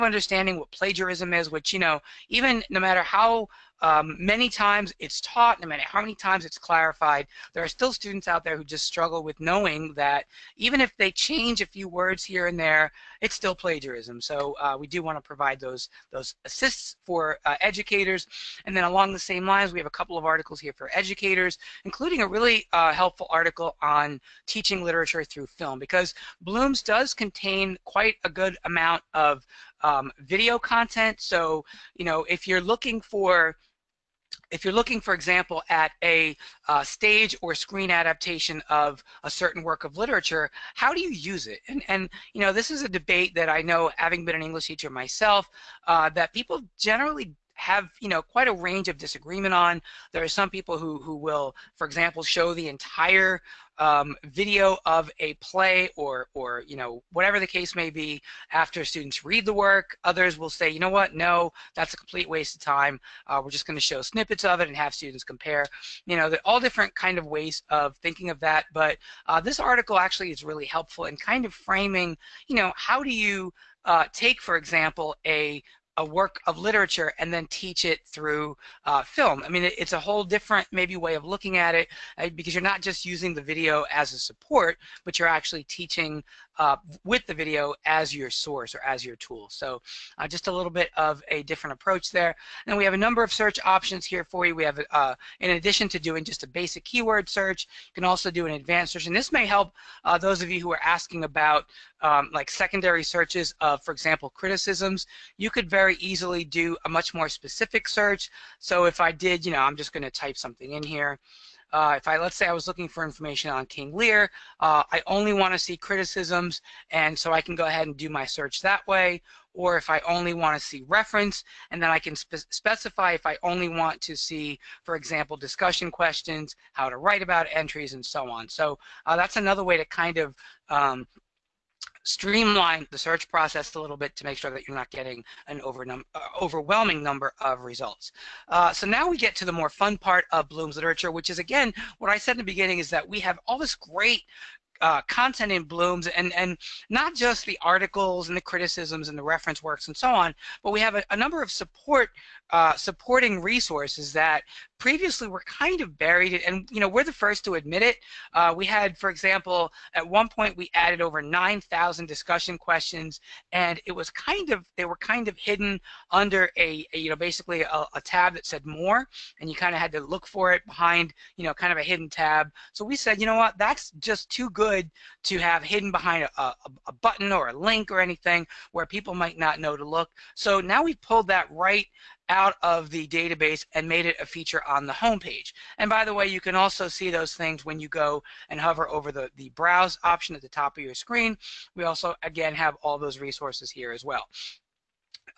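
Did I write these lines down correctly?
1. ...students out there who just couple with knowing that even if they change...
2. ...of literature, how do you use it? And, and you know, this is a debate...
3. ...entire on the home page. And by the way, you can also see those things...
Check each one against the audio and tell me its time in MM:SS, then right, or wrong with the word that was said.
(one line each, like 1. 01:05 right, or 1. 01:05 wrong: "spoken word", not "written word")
1. 00:07 wrong: "struggle", not "couple"
2. 00:39 right
3. 03:04 wrong: "feature", not "entire".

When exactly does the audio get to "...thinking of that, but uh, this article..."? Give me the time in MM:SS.
01:07.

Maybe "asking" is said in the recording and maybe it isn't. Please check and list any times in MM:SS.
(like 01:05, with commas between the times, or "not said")
01:40.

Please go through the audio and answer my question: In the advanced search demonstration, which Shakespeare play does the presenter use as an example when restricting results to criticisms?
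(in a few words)
King Lear.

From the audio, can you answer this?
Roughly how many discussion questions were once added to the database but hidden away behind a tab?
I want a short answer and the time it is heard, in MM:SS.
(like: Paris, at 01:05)
9,000, at 02:41.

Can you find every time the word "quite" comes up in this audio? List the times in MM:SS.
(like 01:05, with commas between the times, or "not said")
00:27, 00:48.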